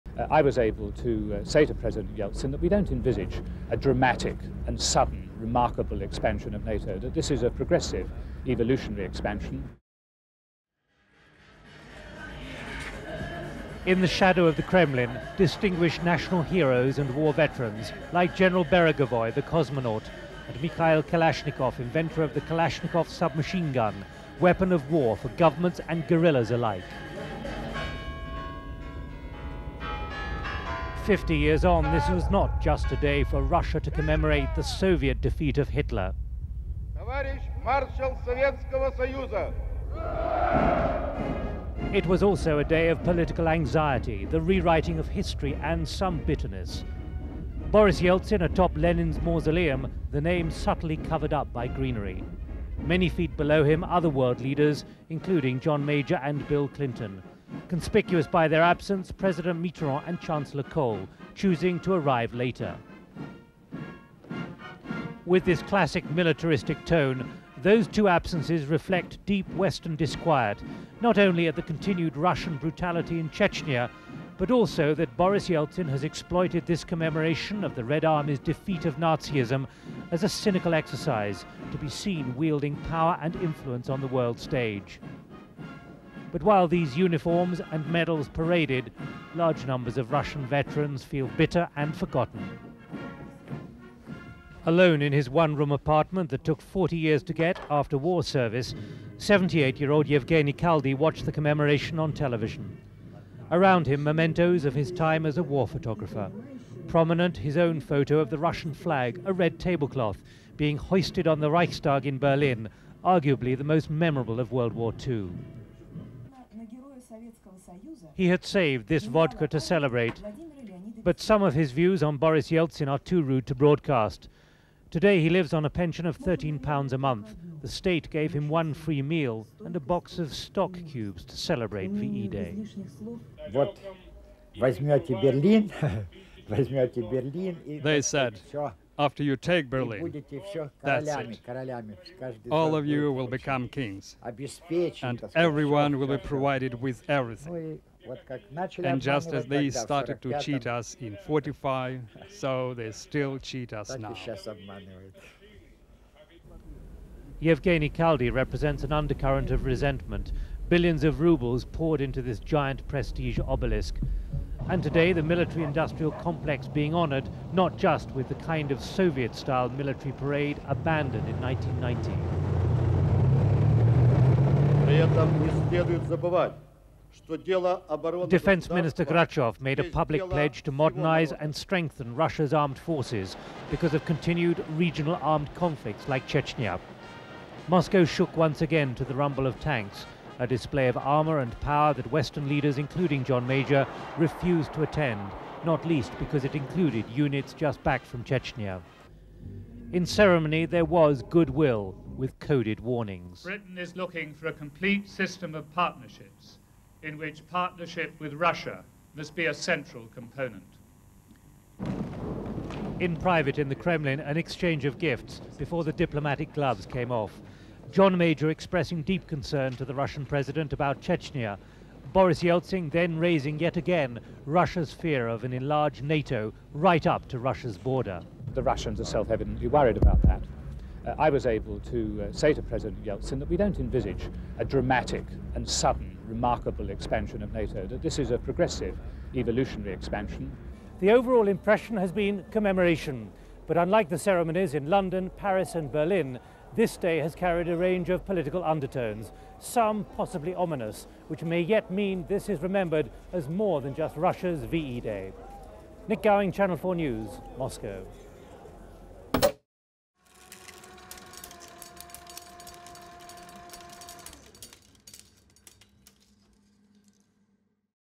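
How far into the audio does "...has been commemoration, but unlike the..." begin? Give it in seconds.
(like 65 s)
241 s.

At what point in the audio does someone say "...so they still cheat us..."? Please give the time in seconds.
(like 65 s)
152 s.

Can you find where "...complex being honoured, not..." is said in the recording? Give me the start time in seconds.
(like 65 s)
166 s.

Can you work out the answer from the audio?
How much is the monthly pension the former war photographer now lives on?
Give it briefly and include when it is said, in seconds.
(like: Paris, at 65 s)
£13, at 126 s.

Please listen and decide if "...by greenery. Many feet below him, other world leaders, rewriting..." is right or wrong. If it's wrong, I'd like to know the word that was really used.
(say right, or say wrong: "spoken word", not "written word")
wrong: "including", not "rewriting".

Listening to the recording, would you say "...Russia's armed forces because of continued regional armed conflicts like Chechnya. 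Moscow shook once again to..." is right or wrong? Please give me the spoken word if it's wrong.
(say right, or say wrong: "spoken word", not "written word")
right.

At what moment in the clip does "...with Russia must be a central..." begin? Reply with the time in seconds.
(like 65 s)
208 s.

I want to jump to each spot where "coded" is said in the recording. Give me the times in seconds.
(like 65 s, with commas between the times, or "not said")
202 s.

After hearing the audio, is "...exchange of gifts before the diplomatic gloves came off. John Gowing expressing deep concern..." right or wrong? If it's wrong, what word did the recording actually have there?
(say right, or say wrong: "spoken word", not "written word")
wrong: "Major", not "Gowing".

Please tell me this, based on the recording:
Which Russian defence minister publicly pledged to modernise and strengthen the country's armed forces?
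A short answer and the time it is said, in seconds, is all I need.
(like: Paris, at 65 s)
Grachev, at 179 s.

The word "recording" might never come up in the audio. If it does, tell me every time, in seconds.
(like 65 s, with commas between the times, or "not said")
not said.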